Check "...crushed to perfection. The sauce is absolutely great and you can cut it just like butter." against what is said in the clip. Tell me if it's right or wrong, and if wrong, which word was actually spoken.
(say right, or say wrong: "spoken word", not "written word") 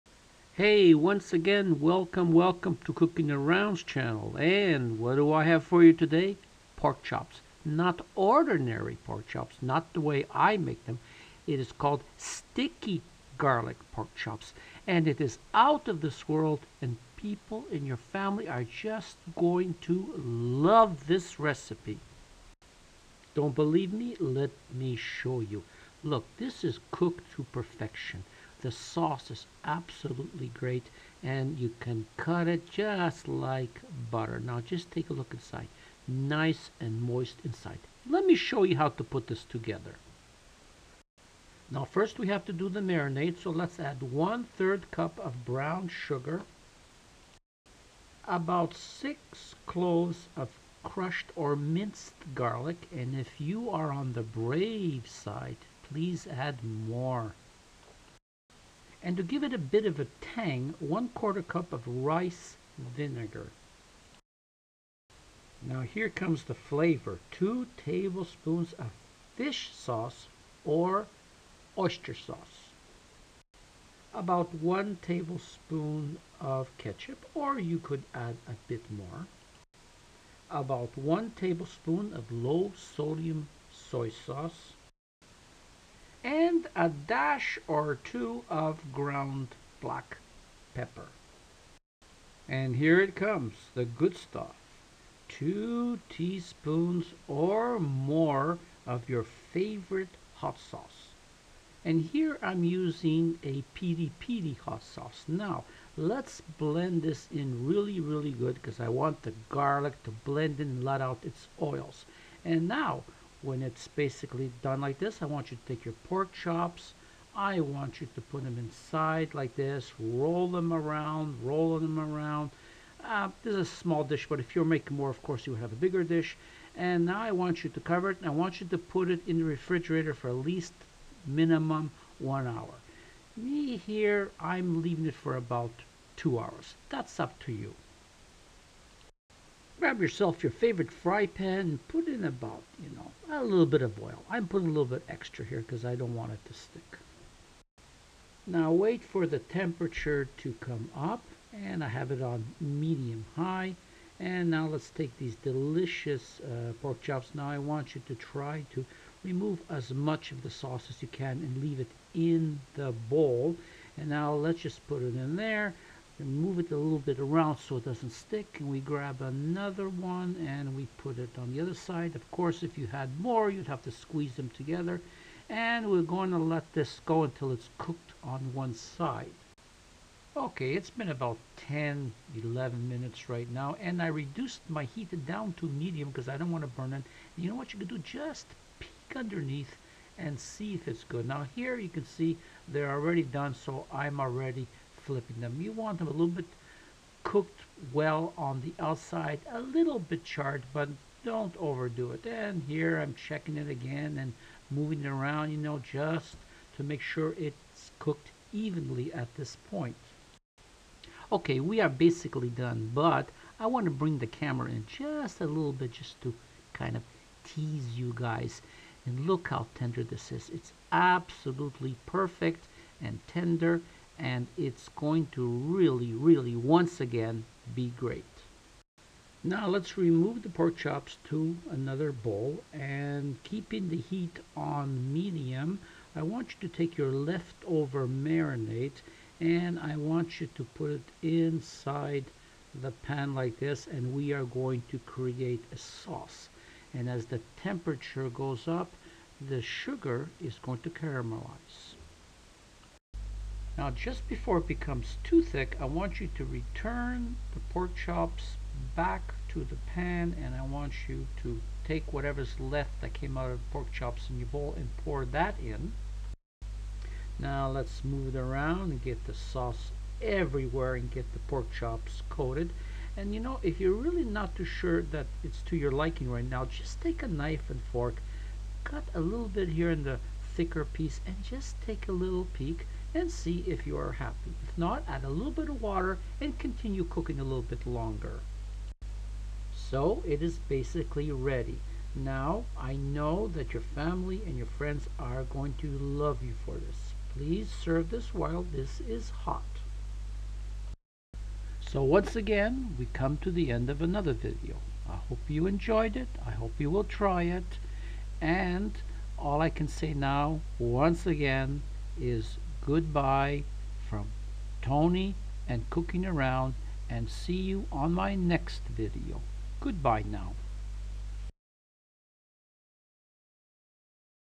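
wrong: "cooked", not "crushed".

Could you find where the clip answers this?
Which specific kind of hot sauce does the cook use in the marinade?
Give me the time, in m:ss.
1:43.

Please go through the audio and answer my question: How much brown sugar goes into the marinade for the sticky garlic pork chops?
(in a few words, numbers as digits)
1/3 cup.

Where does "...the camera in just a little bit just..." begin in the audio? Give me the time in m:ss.
3:34.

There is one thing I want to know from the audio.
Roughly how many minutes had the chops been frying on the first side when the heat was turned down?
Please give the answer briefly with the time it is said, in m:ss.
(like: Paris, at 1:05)
10 to 11 minutes, at 3:01.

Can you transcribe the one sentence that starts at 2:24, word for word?
I'm putting a little bit extra here because I don't want it to stick.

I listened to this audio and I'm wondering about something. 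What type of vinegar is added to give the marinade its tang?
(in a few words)
Rice vinegar.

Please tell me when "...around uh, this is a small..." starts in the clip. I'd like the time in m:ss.
2:01.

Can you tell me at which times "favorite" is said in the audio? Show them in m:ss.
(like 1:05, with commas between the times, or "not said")
1:39, 2:20.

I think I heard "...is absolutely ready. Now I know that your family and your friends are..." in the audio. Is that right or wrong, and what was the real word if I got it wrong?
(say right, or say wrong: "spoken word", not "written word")
wrong: "basically", not "absolutely".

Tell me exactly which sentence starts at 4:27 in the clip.
Now let's move it around and get the sauce everywhere and get the pork chops coated.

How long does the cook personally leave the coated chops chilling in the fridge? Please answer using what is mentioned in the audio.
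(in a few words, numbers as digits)
About 2 hours.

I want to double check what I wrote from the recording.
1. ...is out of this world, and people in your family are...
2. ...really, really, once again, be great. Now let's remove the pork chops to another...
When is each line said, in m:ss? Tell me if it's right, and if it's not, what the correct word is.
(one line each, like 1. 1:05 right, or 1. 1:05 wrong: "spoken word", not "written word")
1. 0:15 right
2. 3:45 right.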